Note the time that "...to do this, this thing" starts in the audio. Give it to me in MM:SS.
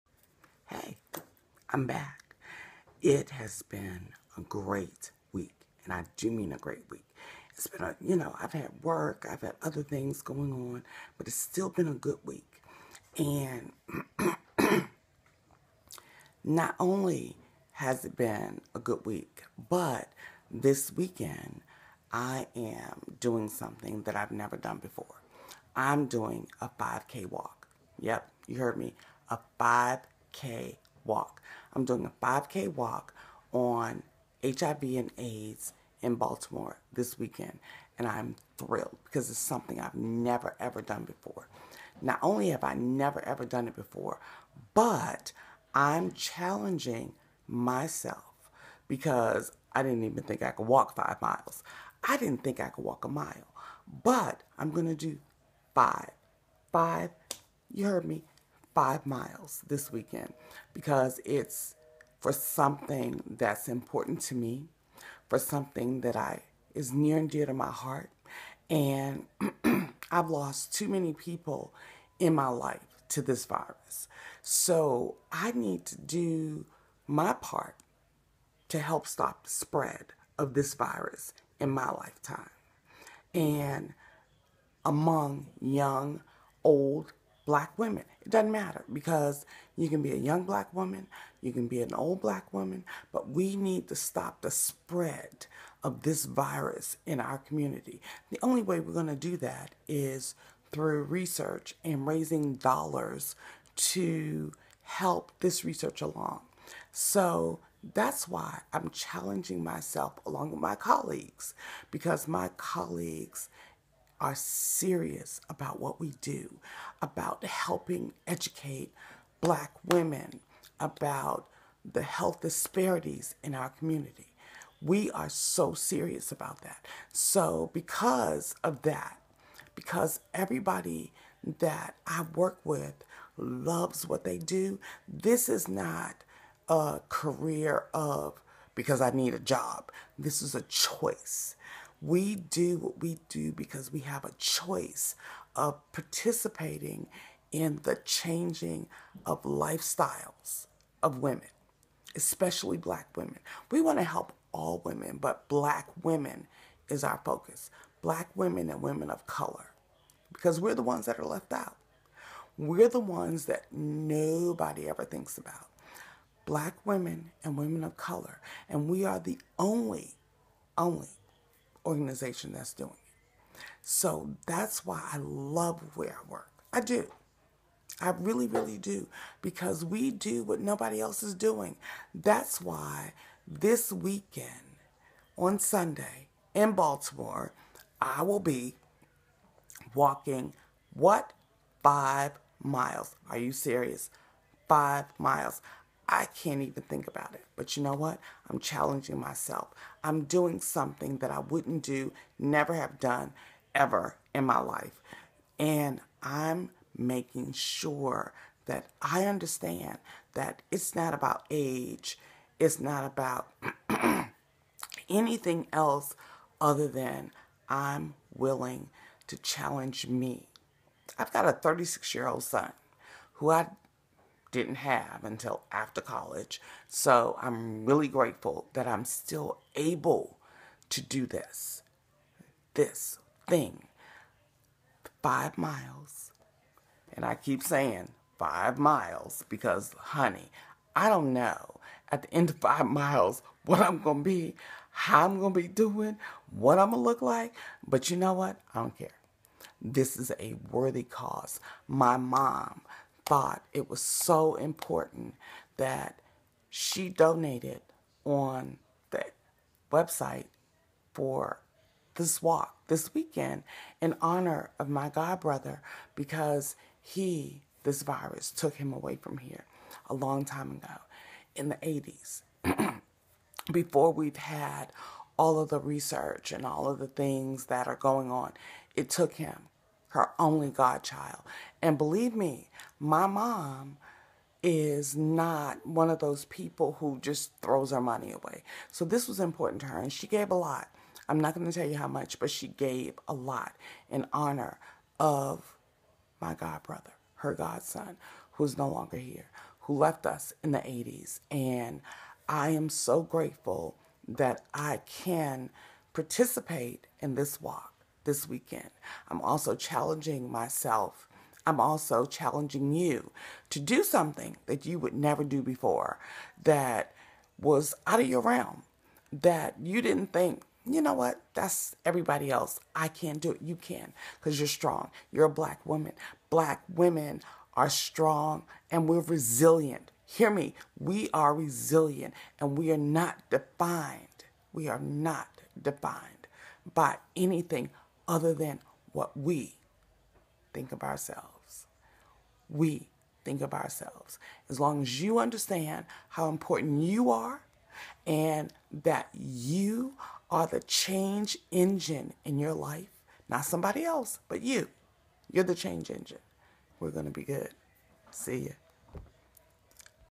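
03:50.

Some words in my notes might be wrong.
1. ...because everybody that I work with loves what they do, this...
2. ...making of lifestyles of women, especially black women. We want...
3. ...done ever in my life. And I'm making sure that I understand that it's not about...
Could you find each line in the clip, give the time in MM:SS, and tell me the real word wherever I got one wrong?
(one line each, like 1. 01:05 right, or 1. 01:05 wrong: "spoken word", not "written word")
1. 02:09 right
2. 02:28 wrong: "changing", not "making"
3. 03:22 right.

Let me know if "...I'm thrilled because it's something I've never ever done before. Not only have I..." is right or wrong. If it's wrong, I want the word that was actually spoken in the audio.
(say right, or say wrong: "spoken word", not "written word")
right.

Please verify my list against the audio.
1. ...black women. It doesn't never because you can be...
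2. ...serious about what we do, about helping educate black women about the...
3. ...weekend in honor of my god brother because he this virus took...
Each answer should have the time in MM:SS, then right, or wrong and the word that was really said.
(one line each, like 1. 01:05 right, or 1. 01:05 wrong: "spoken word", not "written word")
1. 01:27 wrong: "matter", not "never"
2. 01:54 right
3. 04:23 right.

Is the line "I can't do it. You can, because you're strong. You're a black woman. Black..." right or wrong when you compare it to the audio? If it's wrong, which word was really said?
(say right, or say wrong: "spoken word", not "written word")
right.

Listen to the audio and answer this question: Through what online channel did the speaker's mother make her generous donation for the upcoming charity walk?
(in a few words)
the website.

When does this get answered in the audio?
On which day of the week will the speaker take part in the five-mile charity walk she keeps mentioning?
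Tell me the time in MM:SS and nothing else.
03:05.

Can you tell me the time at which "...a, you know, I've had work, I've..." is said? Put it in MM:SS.
00:07.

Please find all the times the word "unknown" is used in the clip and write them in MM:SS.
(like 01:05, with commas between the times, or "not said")
not said.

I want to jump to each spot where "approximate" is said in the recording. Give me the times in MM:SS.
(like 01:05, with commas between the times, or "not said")
not said.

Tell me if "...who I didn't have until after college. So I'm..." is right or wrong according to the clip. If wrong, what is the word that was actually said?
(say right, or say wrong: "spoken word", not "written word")
right.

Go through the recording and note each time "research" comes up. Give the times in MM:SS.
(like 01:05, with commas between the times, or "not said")
01:41, 01:45, 04:35.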